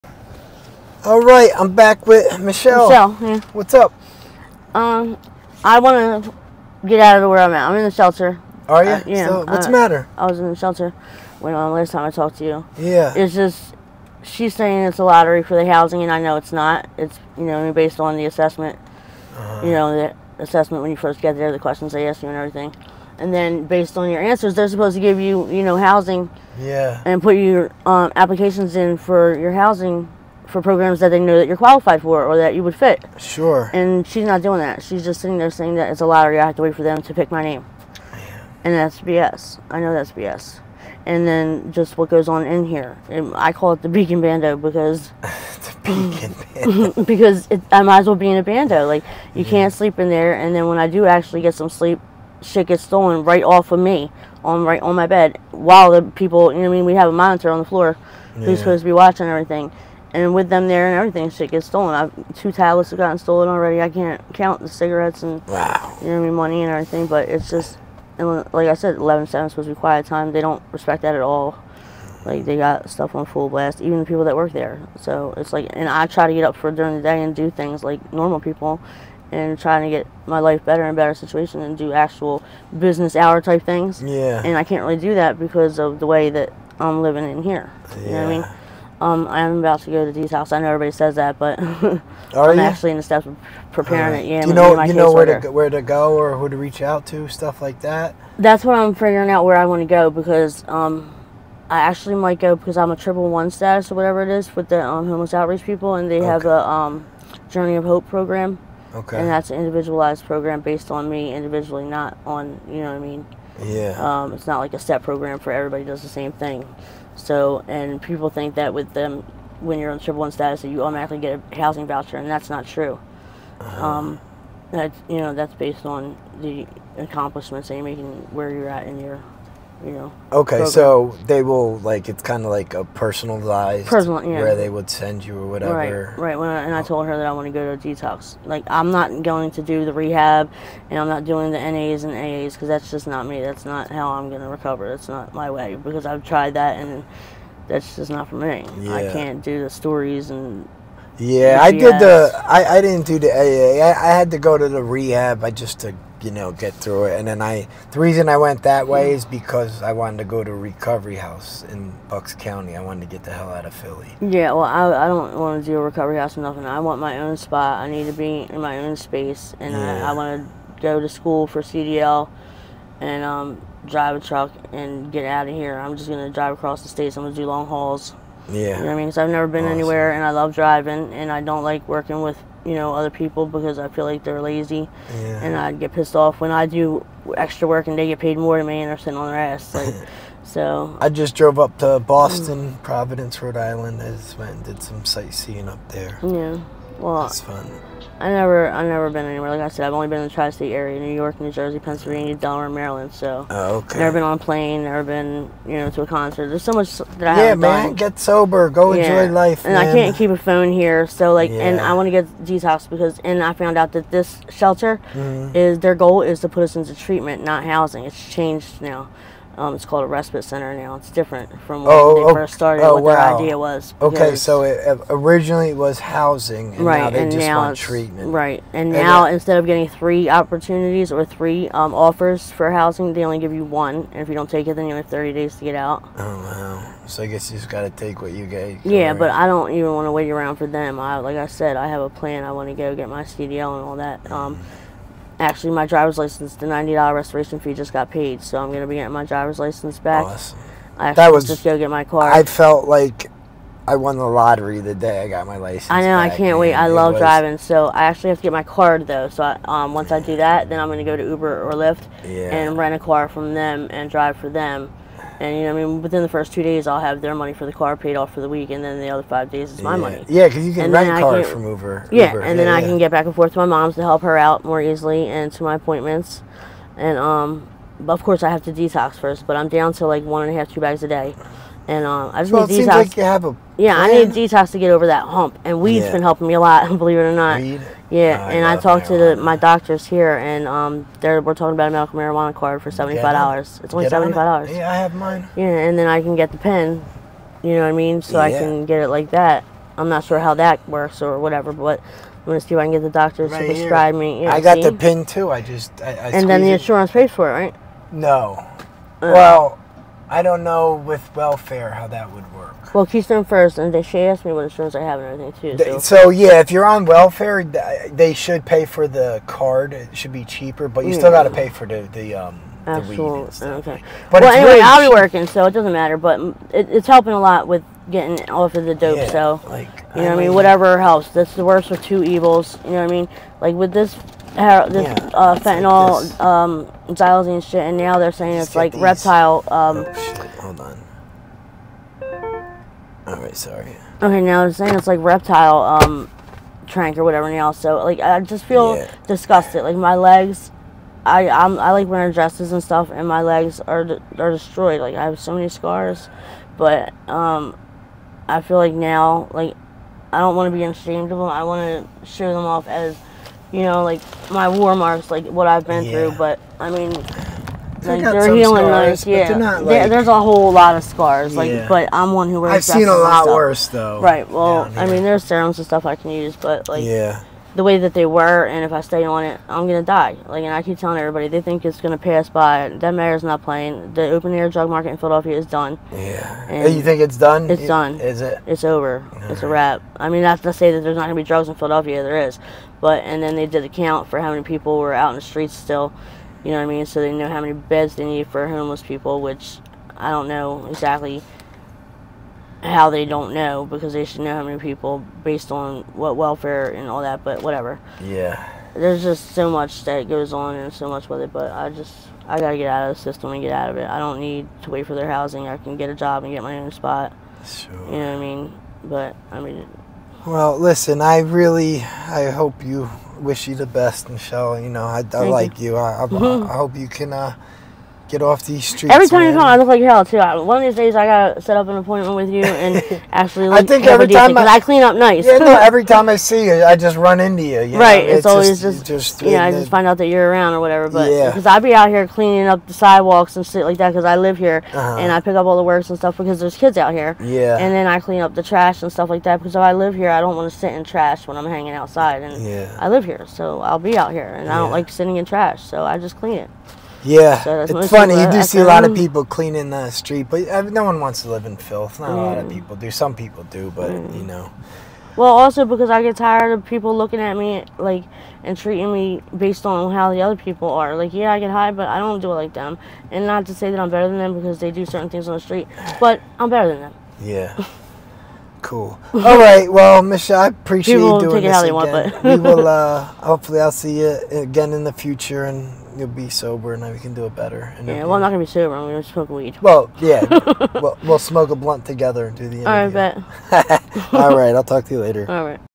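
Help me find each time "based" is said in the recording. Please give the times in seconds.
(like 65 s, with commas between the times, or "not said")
17 s, 23 s, 110 s, 125 s, 405 s, 469 s.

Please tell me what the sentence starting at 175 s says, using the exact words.
I'm just gonna drive across the states.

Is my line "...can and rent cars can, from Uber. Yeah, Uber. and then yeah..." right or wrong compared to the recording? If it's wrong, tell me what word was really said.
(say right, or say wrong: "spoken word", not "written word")
right.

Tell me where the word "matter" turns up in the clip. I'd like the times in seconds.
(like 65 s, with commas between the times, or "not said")
9 s, 325 s.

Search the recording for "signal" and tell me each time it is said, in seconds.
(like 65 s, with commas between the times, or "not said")
not said.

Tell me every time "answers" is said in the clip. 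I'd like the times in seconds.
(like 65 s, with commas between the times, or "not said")
24 s.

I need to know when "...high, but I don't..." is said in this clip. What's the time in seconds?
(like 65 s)
471 s.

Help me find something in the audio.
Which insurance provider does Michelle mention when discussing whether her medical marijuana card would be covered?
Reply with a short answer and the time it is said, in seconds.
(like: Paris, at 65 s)
Keystone First, at 313 s.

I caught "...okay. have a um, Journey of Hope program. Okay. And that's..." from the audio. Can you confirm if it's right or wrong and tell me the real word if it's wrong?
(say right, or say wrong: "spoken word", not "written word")
right.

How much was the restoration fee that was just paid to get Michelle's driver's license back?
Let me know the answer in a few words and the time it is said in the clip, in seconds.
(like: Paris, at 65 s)
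$90, at 246 s.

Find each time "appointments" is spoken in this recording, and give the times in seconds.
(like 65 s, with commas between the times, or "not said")
275 s, 431 s.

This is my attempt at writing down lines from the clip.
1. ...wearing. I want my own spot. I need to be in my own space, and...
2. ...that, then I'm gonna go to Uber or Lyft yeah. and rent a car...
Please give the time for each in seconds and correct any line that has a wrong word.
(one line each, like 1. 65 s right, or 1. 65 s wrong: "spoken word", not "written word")
1. 166 s wrong: "nothing", not "wearing"
2. 260 s right.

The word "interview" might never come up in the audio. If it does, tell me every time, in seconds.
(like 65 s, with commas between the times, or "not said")
492 s.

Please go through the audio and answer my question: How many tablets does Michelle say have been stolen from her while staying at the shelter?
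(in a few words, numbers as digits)
2.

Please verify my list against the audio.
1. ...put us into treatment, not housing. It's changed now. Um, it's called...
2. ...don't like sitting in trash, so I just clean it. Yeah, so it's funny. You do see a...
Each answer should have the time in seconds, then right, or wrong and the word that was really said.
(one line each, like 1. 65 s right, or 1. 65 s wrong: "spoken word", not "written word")
1. 216 s right
2. 454 s right.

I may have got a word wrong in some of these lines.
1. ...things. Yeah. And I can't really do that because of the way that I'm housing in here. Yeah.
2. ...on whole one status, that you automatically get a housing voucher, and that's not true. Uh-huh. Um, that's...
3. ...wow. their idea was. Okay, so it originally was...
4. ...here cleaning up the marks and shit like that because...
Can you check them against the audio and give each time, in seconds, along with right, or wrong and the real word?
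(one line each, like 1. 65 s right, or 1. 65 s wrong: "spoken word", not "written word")
1. 83 s wrong: "living", not "housing"
2. 119 s wrong: "triple", not "whole"
3. 223 s right
4. 442 s wrong: "sidewalks", not "marks".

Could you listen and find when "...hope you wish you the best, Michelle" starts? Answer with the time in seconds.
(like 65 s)
422 s.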